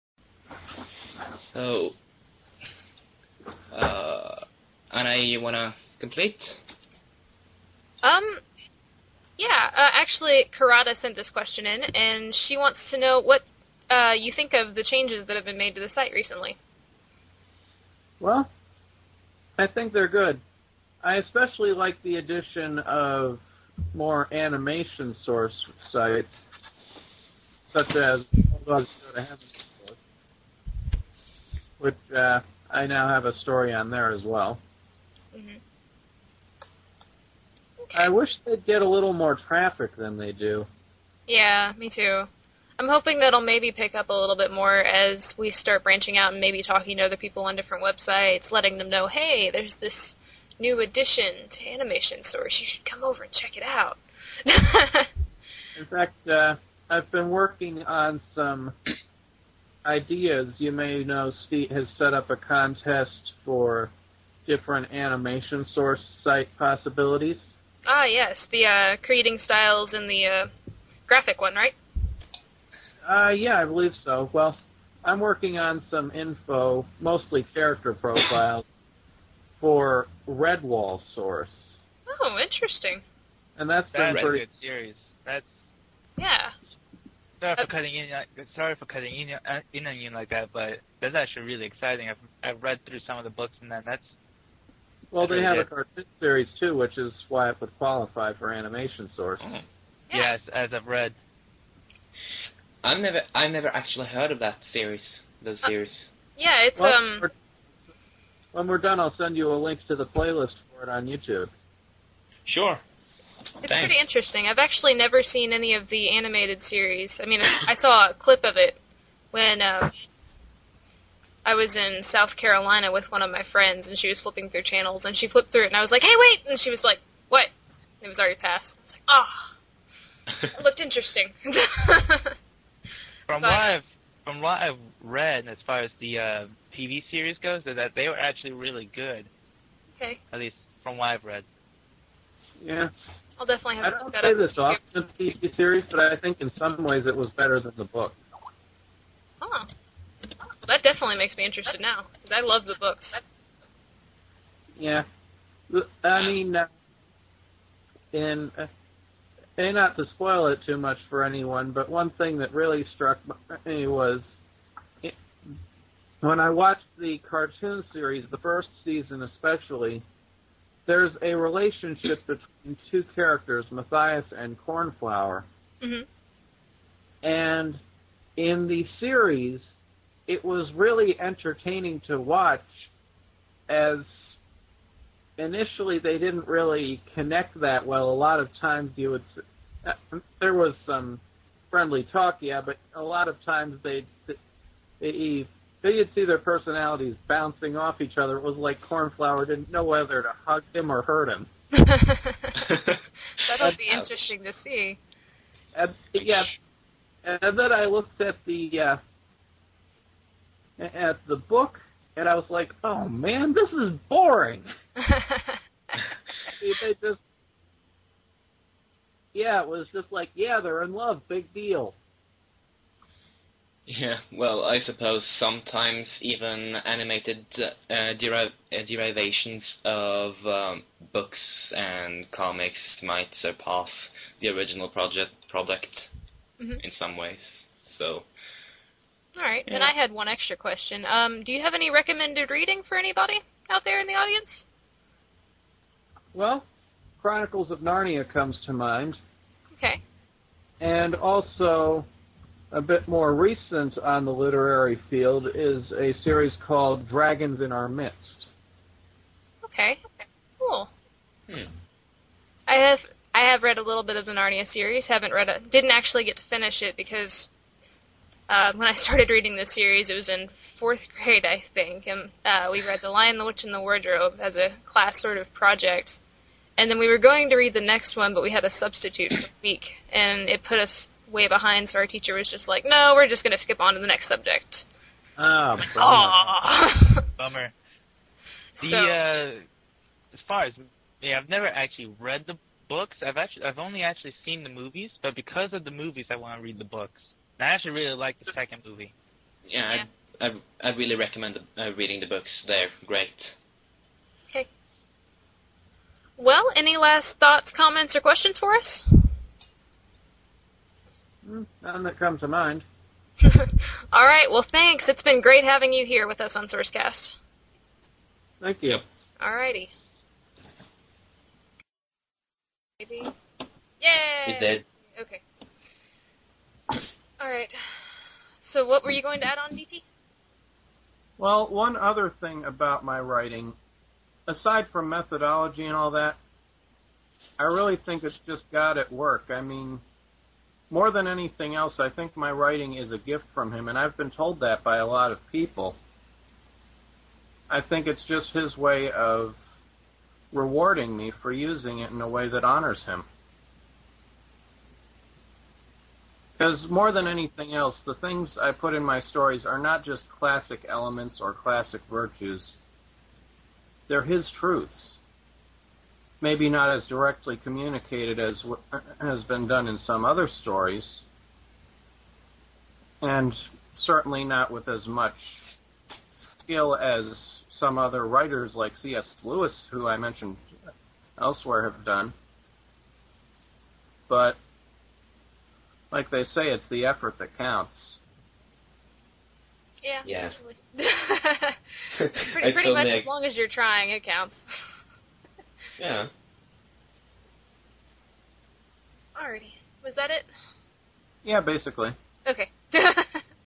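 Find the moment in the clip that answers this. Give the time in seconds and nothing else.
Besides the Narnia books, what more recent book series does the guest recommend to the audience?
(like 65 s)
257 s.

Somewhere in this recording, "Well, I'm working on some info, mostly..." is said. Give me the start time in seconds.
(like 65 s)
74 s.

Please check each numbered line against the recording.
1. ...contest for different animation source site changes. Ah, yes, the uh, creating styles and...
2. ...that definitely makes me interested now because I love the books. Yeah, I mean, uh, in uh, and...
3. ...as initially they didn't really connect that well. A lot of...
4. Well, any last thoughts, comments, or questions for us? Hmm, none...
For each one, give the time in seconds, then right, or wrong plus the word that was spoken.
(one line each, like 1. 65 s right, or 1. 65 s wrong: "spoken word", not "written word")
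1. 62 s wrong: "possibilities", not "changes"
2. 150 s right
3. 183 s right
4. 306 s right.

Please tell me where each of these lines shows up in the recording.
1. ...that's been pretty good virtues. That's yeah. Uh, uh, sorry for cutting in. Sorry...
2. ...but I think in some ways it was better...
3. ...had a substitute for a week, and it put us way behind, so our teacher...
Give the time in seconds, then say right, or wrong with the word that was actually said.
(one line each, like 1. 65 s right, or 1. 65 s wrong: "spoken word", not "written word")
1. 83 s wrong: "series", not "virtues"
2. 145 s right
3. 278 s right.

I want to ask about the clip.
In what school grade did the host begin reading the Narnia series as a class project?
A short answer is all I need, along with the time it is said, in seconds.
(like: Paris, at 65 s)
4th grade, at 270 s.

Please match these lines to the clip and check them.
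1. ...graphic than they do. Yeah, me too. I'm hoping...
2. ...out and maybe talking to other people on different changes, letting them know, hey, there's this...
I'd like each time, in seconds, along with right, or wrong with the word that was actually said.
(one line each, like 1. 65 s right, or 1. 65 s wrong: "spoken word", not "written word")
1. 39 s wrong: "traffic", not "graphic"
2. 46 s wrong: "websites", not "changes".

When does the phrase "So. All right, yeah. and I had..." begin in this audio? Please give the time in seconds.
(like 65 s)
237 s.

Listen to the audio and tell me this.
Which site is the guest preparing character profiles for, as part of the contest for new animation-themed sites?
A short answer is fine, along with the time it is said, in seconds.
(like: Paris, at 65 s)
Redwall Source, at 80 s.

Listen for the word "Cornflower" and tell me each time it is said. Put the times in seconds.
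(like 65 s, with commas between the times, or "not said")
174 s, 198 s.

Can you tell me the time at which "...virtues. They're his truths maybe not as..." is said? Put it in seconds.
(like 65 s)
362 s.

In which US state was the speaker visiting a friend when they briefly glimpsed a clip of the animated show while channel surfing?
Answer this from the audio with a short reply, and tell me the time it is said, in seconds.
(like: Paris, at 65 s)
South Carolina, at 122 s.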